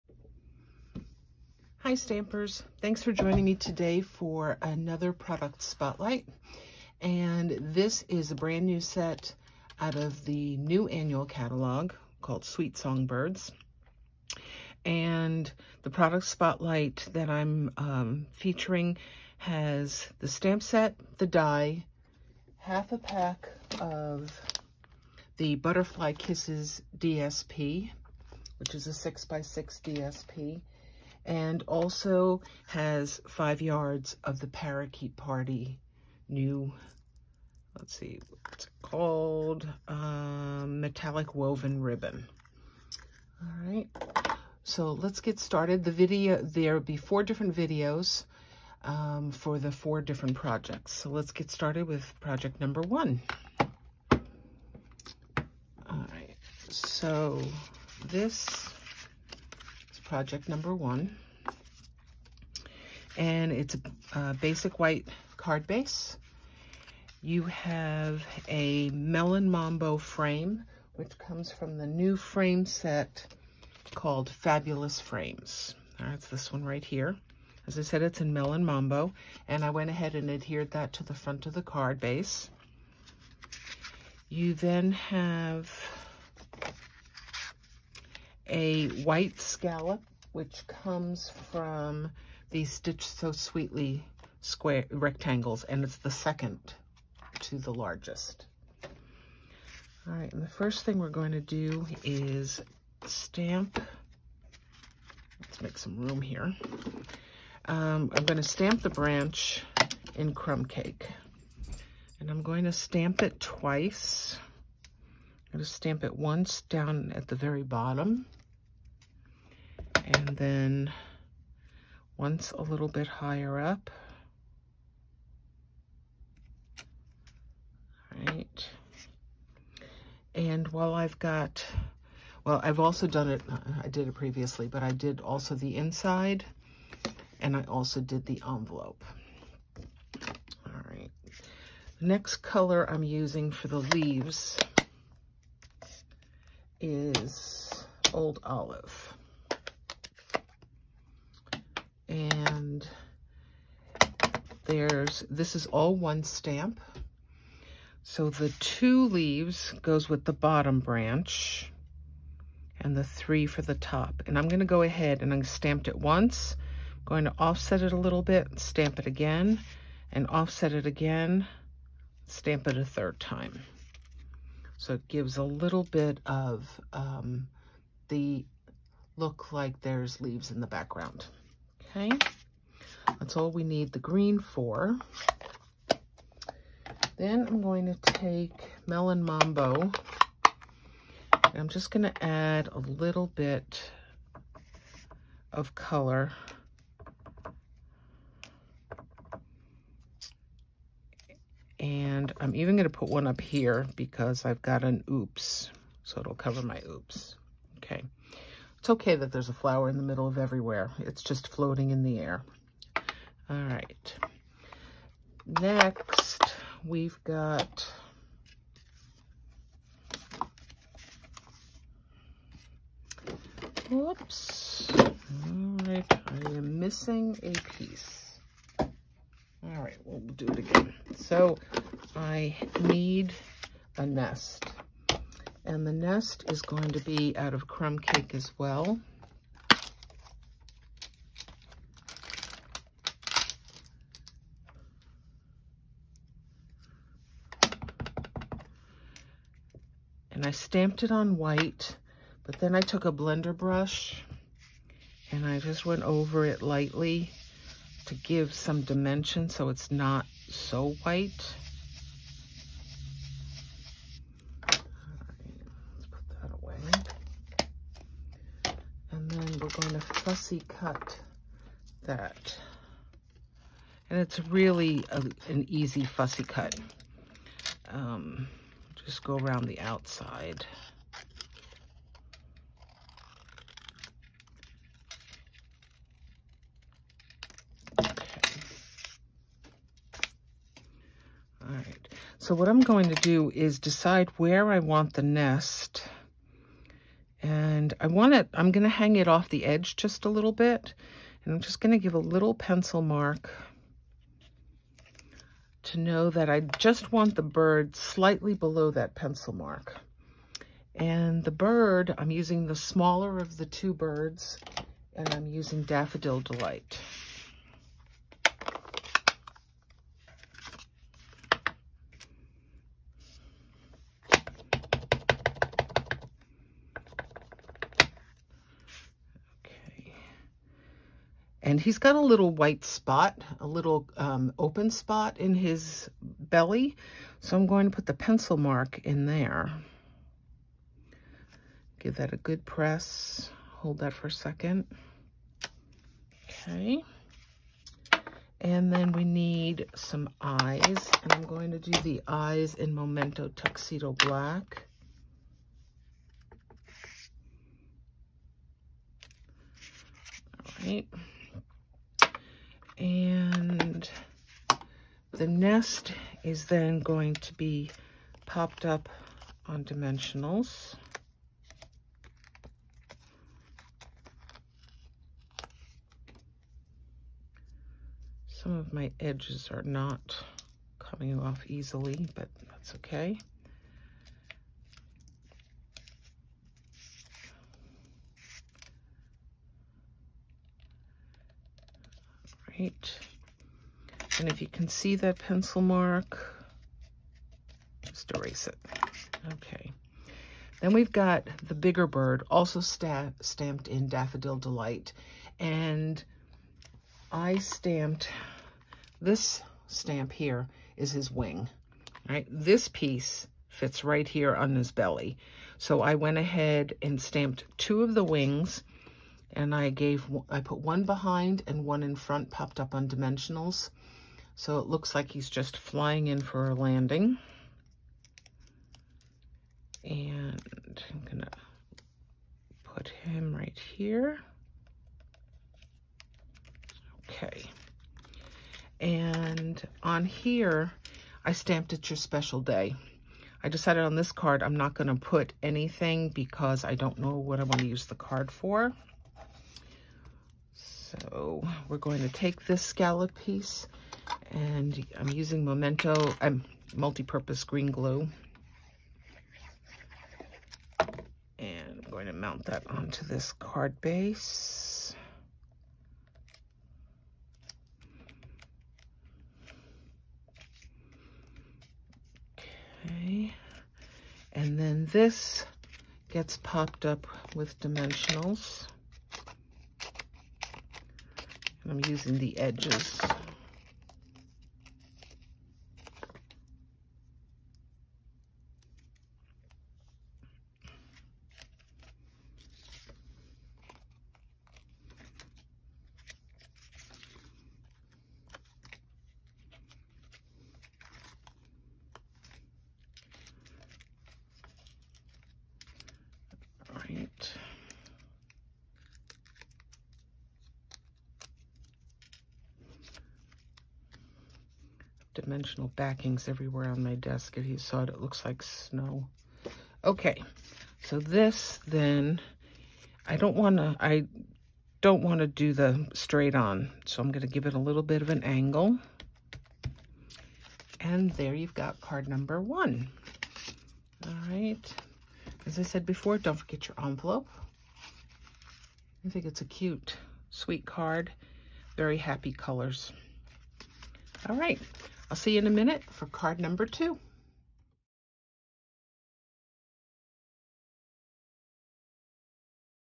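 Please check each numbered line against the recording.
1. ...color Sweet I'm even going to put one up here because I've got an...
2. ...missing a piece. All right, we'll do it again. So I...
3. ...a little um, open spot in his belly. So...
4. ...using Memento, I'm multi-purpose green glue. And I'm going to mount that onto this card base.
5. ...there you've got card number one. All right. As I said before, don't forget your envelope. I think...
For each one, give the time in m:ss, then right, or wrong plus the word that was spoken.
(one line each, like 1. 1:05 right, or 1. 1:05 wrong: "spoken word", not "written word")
1. 3:15 wrong: "And", not "Sweet"
2. 3:46 right
3. 5:33 right
4. 7:35 right
5. 8:51 right.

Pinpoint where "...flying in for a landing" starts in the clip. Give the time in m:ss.
7:05.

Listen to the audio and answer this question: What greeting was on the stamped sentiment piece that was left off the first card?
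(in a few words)
your special day.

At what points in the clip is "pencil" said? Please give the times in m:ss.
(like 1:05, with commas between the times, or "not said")
5:02, 5:09, 5:38, 6:35.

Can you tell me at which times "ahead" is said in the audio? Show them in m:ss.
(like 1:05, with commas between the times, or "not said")
1:19, 2:44, 6:56.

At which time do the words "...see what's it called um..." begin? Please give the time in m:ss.
0:37.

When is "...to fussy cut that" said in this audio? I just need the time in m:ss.
4:29.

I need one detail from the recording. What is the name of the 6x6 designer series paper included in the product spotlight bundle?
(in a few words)
Butterfly Kisses.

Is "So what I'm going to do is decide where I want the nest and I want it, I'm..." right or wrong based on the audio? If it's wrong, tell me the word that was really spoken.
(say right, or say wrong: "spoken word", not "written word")
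right.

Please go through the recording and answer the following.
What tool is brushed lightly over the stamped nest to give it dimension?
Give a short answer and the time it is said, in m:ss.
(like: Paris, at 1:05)
blender brush, at 4:13.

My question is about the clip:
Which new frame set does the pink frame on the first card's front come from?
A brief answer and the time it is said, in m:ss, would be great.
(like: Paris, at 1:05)
Fabulous Frames, at 1:14.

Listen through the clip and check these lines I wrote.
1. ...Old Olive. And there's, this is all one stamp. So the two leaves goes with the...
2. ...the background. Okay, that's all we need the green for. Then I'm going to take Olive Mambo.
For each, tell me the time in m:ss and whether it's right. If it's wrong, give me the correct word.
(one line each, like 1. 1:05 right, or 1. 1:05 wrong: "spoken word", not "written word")
1. 2:28 right
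2. 3:00 wrong: "Melon", not "Olive".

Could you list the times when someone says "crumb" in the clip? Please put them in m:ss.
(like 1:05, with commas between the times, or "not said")
1:50, 3:57.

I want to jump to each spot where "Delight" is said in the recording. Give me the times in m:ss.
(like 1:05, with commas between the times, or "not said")
5:16, 6:44.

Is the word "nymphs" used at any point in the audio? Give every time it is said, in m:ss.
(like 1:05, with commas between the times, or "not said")
not said.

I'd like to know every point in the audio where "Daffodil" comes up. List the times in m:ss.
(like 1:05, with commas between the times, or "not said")
5:15, 6:44.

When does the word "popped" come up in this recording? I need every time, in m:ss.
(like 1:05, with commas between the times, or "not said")
6:08, 7:02, 7:56.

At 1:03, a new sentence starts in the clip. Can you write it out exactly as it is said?
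And it's a, a basic white card base.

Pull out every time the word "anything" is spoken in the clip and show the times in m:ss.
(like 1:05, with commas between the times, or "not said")
7:25.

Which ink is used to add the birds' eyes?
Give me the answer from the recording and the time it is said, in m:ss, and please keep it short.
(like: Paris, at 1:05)
Memento Tuxedo Black, at 5:52.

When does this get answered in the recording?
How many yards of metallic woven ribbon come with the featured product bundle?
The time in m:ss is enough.
0:33.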